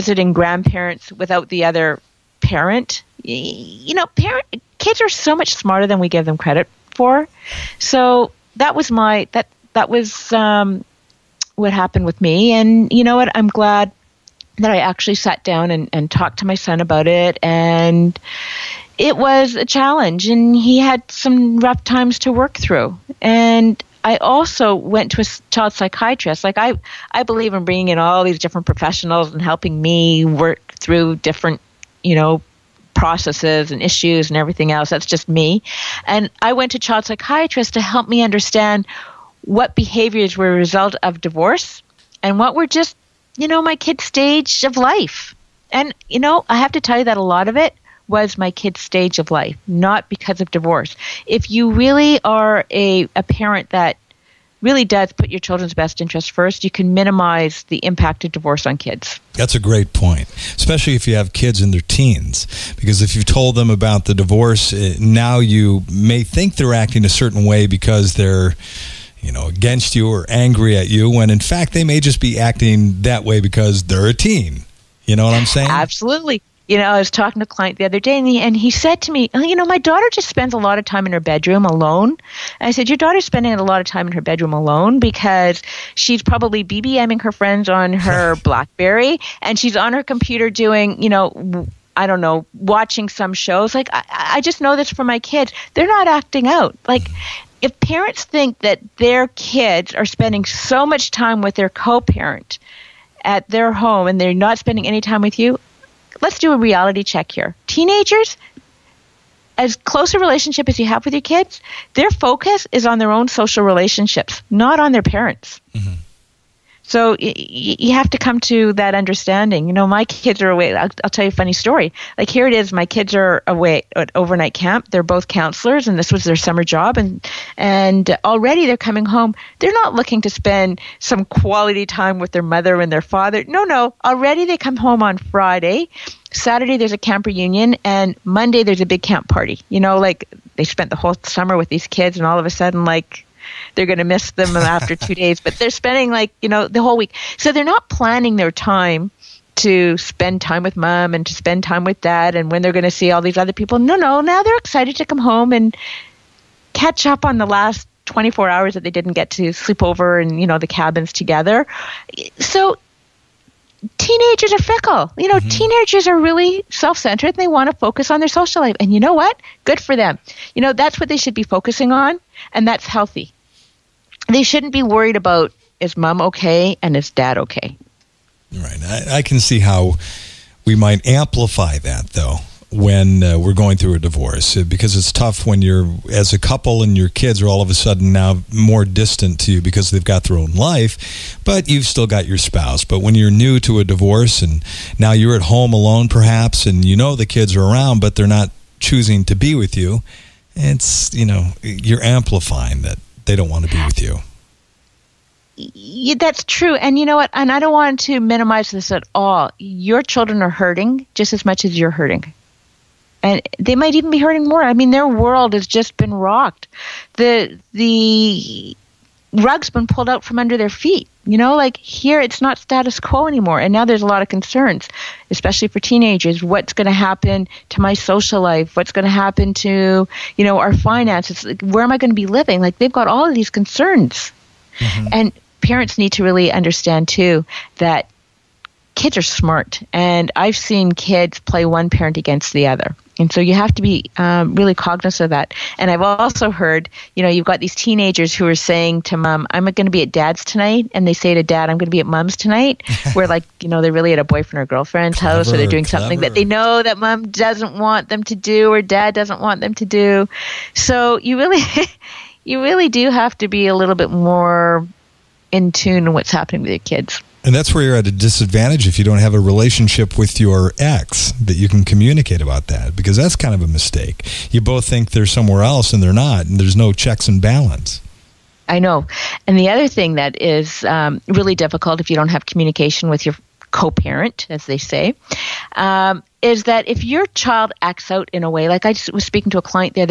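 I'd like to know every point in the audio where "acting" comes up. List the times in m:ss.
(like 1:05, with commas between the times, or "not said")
1:06, 1:12, 1:36.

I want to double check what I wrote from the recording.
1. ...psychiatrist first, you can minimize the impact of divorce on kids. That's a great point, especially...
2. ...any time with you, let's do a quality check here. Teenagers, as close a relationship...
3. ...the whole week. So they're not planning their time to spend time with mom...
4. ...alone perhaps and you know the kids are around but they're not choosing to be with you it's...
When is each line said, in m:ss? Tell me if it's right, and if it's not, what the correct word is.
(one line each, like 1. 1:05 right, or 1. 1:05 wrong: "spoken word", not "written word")
1. 0:56 wrong: "interest", not "psychiatrist"
2. 1:44 wrong: "reality", not "quality"
3. 2:26 right
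4. 3:15 right.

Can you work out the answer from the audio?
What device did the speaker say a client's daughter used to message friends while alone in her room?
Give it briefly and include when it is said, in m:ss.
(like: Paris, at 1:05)
Blackberry, at 1:28.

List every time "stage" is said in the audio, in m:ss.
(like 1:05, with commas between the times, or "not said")
0:44, 0:48.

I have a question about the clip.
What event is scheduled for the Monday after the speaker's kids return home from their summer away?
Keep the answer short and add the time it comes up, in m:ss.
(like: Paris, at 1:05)
A big camp party, at 2:18.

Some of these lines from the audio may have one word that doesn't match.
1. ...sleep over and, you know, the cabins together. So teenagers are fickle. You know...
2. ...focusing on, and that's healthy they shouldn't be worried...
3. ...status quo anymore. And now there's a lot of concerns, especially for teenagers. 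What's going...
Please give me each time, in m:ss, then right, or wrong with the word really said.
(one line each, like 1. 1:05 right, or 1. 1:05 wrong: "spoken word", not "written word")
1. 2:39 right
2. 2:51 right
3. 3:42 right.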